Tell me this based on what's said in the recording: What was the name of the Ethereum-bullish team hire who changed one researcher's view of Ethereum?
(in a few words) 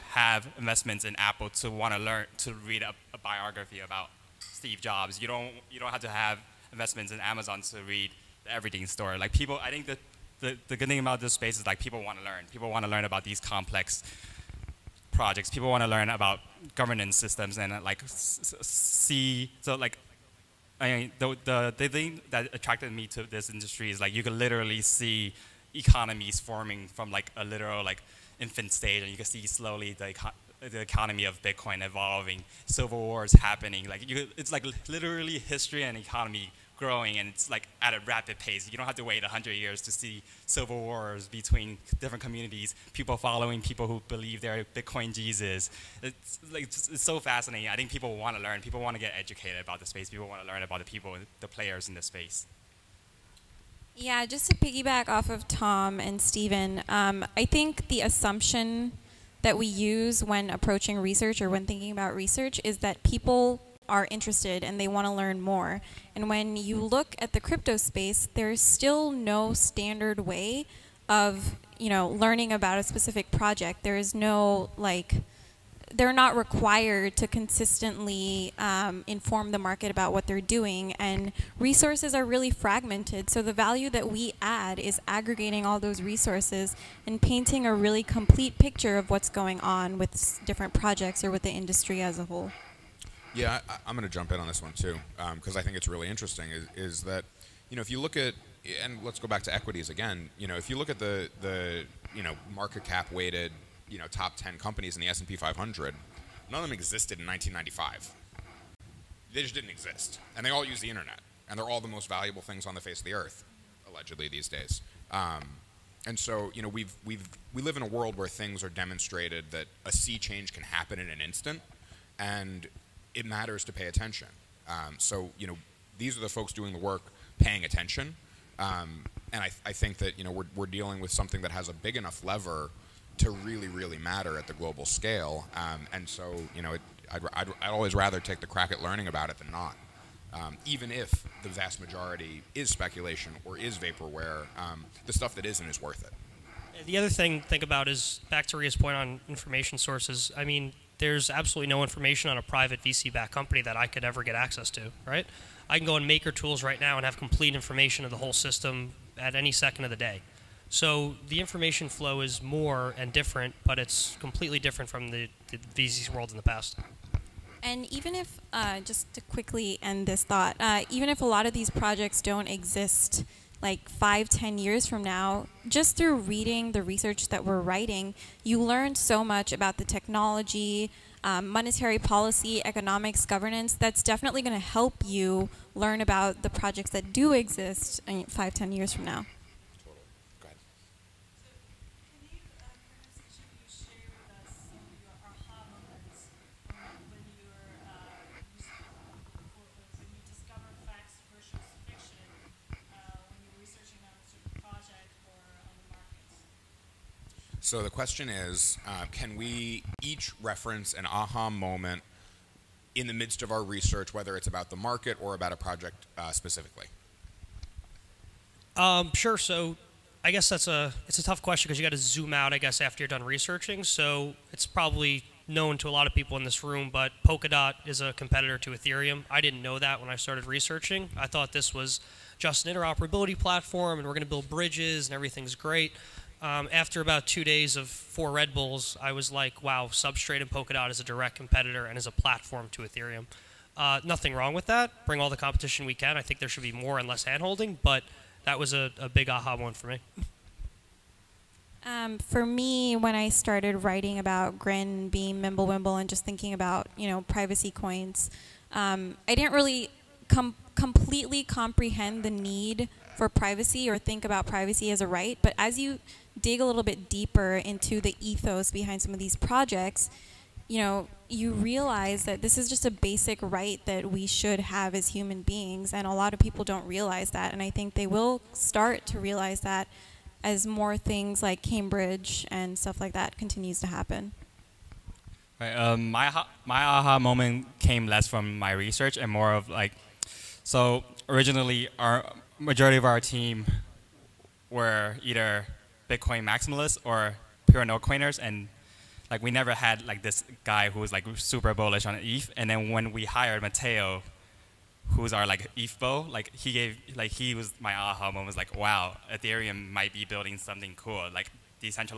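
Mateo.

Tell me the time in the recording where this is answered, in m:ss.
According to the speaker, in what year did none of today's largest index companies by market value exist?
1:47.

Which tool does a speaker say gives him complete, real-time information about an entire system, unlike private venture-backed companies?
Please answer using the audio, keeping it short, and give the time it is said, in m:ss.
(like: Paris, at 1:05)
Maker Tools, at 2:36.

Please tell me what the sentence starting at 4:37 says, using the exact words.
And I think they will start to realize that as more things like Cambridge and stuff like that continues to happen.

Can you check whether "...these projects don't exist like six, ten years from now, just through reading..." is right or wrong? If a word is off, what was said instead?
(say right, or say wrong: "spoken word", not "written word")
wrong: "five", not "six".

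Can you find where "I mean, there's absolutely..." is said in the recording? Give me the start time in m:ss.
2:30.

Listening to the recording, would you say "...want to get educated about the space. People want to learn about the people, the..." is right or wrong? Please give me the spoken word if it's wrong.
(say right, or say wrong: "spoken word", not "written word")
right.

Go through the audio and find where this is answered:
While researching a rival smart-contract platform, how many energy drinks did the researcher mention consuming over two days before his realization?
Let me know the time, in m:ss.
3:57.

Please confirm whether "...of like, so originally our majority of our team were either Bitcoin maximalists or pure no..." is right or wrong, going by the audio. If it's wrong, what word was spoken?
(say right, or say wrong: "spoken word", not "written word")
right.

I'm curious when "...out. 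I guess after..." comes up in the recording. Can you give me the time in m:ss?
3:42.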